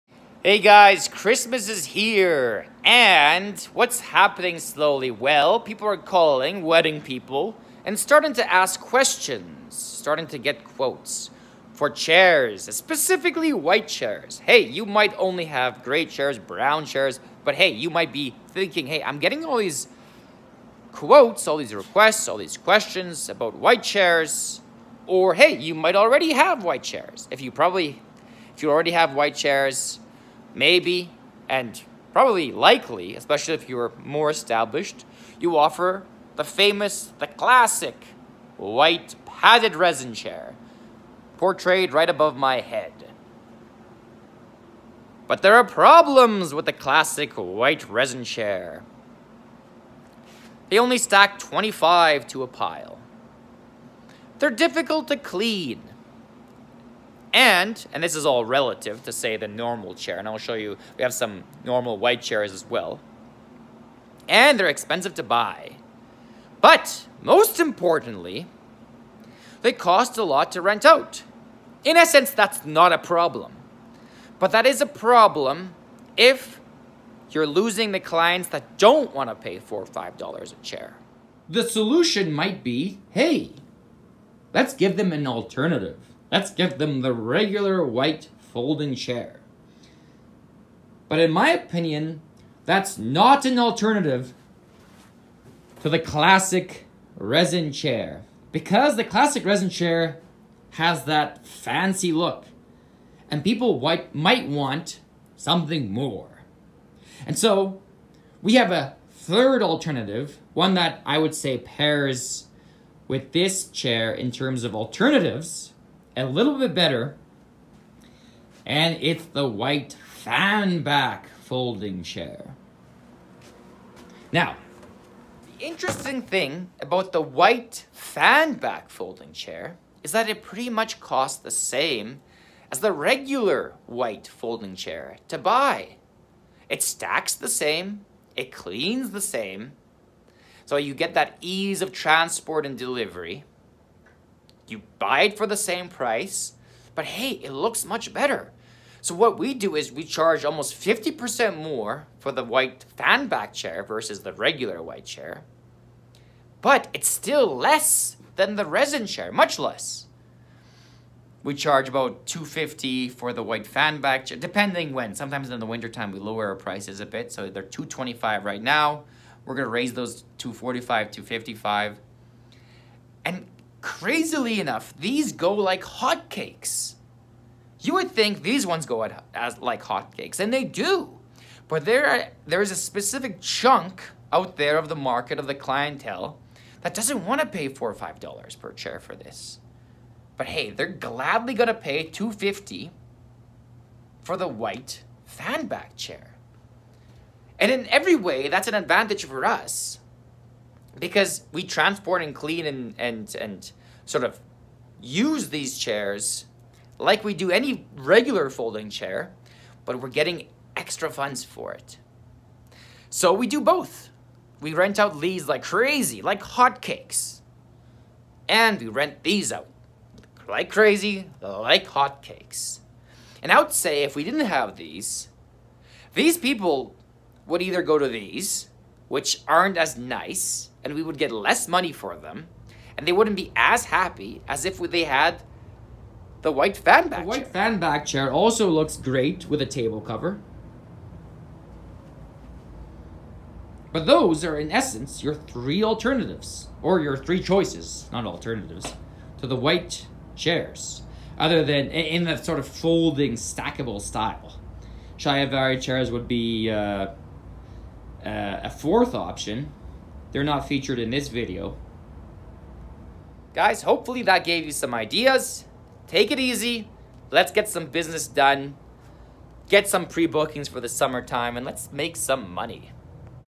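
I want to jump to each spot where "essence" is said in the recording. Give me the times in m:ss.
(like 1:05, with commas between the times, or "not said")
1:11, 4:04.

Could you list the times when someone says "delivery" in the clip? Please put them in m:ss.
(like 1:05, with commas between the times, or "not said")
2:22.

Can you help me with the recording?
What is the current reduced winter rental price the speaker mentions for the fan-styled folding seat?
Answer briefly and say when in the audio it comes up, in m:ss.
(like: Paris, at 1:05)
$2.25, at 2:47.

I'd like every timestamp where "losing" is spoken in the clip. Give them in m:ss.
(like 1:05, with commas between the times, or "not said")
1:17.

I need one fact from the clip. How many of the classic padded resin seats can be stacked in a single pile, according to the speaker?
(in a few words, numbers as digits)
25.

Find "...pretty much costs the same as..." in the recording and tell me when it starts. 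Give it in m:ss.
2:10.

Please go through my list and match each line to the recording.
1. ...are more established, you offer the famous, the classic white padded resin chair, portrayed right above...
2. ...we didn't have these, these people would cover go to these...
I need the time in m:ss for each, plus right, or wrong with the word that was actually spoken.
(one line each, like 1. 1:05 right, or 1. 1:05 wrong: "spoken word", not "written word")
1. 0:33 right
2. 3:44 wrong: "either", not "cover".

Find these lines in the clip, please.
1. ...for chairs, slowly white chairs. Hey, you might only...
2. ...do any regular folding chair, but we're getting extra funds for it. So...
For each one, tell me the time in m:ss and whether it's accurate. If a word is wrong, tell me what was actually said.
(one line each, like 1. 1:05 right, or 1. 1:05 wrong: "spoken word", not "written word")
1. 0:11 wrong: "specifically", not "slowly"
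2. 3:27 right.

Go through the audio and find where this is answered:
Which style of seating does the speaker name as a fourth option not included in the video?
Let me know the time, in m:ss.
4:15.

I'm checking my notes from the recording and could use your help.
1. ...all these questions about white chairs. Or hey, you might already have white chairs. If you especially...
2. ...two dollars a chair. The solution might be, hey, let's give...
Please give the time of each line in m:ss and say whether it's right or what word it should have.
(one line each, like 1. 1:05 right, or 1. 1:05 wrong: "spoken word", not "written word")
1. 0:22 wrong: "probably", not "especially"
2. 1:19 wrong: "five", not "two".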